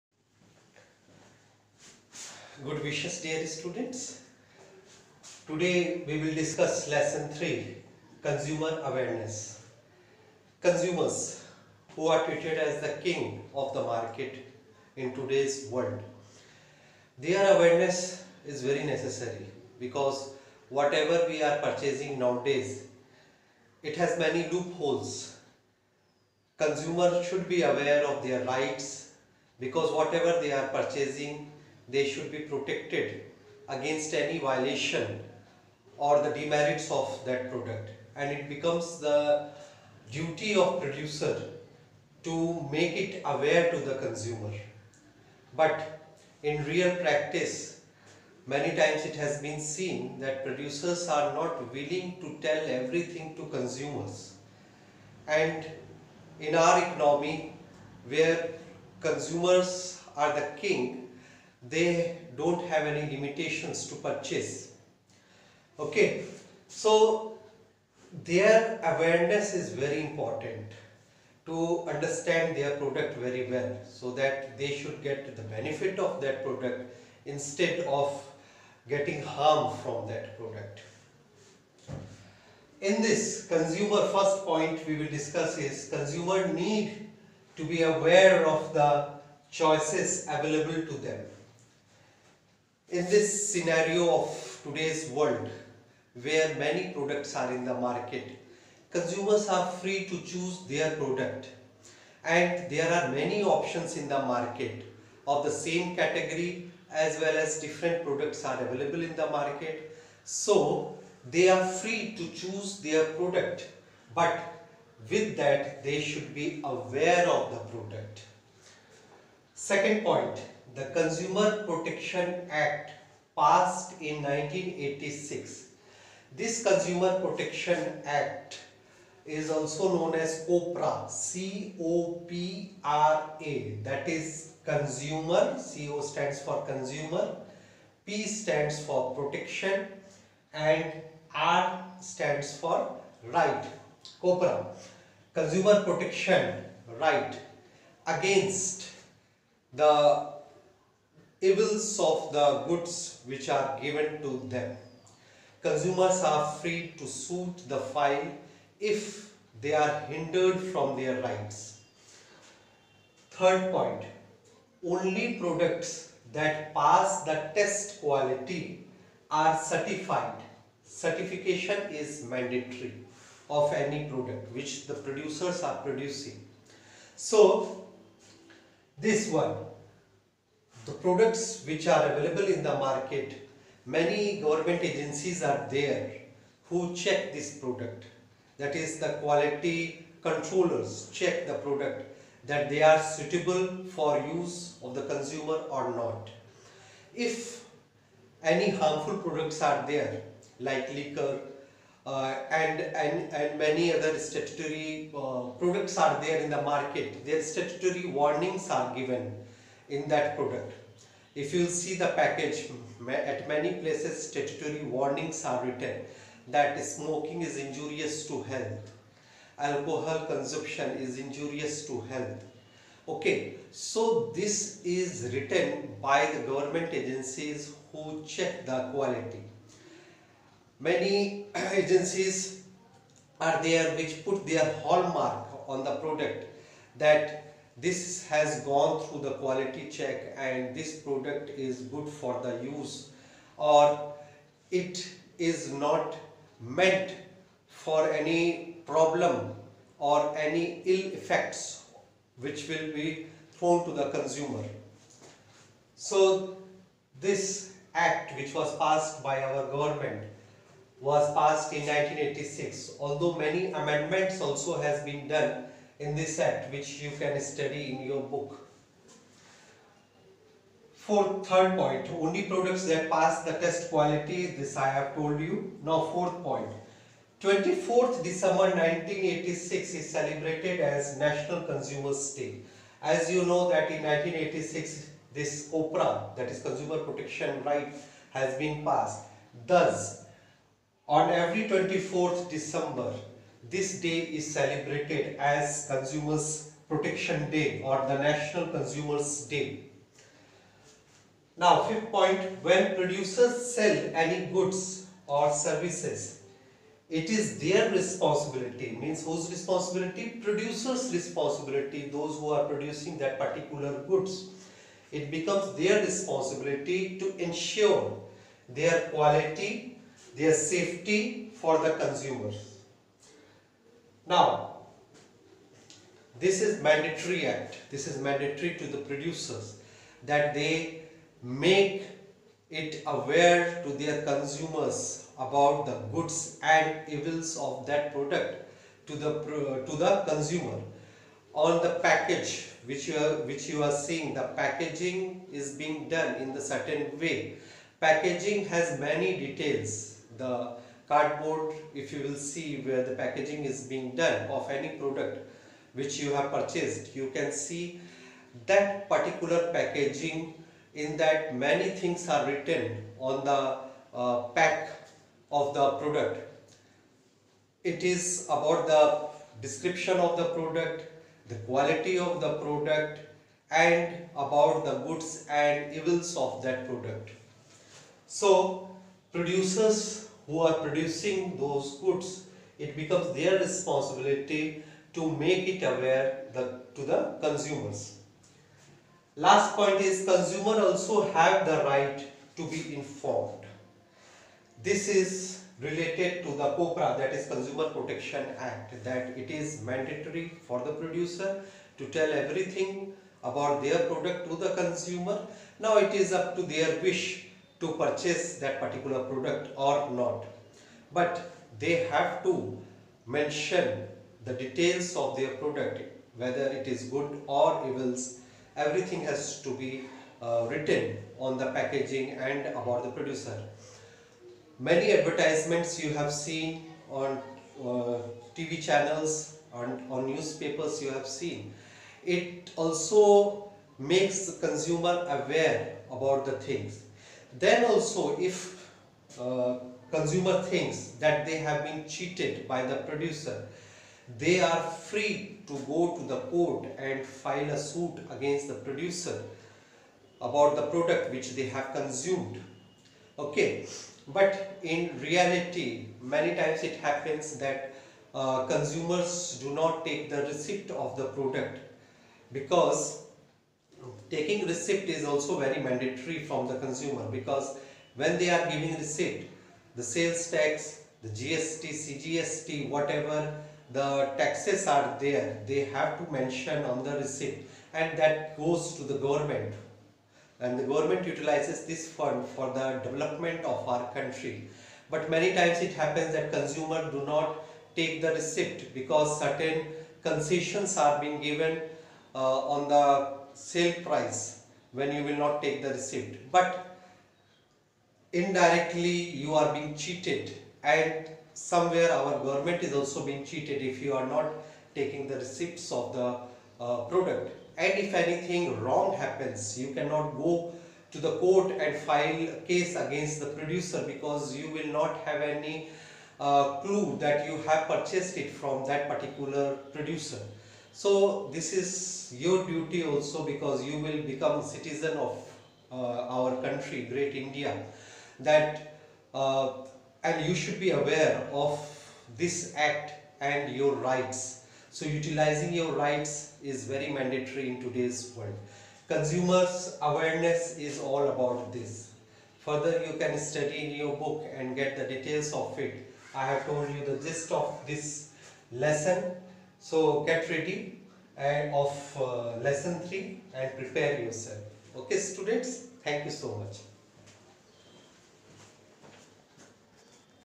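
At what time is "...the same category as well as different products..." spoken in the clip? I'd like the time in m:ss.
1:45.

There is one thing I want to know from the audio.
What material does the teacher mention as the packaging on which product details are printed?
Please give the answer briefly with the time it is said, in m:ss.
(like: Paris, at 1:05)
Cardboard, at 5:50.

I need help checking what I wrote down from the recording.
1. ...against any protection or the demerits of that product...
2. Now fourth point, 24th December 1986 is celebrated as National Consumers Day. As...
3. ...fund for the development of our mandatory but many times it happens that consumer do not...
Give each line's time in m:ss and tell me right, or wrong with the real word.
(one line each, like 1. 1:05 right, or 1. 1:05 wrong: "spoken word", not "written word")
1. 0:33 wrong: "violation", not "protection"
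2. 4:35 right
3. 8:02 wrong: "country", not "mandatory".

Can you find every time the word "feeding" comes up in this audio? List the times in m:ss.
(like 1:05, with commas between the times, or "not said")
not said.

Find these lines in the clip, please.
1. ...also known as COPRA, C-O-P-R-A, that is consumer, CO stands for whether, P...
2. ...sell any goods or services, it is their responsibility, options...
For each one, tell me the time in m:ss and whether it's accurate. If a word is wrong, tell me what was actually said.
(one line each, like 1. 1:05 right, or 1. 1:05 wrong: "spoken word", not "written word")
1. 2:09 wrong: "consumer", not "whether"
2. 5:03 wrong: "means", not "options".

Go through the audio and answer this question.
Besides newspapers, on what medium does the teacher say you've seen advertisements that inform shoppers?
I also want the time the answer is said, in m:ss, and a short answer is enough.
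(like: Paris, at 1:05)
TV channels, at 7:08.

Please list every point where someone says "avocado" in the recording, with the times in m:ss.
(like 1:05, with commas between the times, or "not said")
not said.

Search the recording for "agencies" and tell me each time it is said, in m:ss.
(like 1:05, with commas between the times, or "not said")
3:04, 3:46, 3:51.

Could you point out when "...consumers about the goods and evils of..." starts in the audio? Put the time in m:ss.
5:34.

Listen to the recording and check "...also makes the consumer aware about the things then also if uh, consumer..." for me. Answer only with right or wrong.
right.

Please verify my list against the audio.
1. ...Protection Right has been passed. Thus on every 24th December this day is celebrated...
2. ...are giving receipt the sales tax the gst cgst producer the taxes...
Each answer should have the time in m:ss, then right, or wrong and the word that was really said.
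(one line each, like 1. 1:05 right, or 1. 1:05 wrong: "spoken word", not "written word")
1. 4:46 right
2. 7:48 wrong: "whatever", not "producer".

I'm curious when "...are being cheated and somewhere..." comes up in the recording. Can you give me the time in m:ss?
8:19.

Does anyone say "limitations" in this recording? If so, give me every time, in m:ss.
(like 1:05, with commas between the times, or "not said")
1:03.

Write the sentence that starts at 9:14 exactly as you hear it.
Okay students, thank you so much.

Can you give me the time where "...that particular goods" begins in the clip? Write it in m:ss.
5:13.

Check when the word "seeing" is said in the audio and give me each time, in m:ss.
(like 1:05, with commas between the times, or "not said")
5:44.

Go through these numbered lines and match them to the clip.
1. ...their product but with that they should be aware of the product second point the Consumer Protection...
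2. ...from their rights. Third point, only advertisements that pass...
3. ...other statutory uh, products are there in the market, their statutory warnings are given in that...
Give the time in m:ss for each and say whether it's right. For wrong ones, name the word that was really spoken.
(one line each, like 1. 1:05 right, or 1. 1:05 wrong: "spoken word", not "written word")
1. 1:52 right
2. 2:40 wrong: "products", not "advertisements"
3. 3:23 right.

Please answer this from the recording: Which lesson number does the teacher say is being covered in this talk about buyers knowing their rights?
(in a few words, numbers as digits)
3.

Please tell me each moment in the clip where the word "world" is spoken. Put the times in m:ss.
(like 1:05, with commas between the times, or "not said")
0:15, 1:35, 8:58.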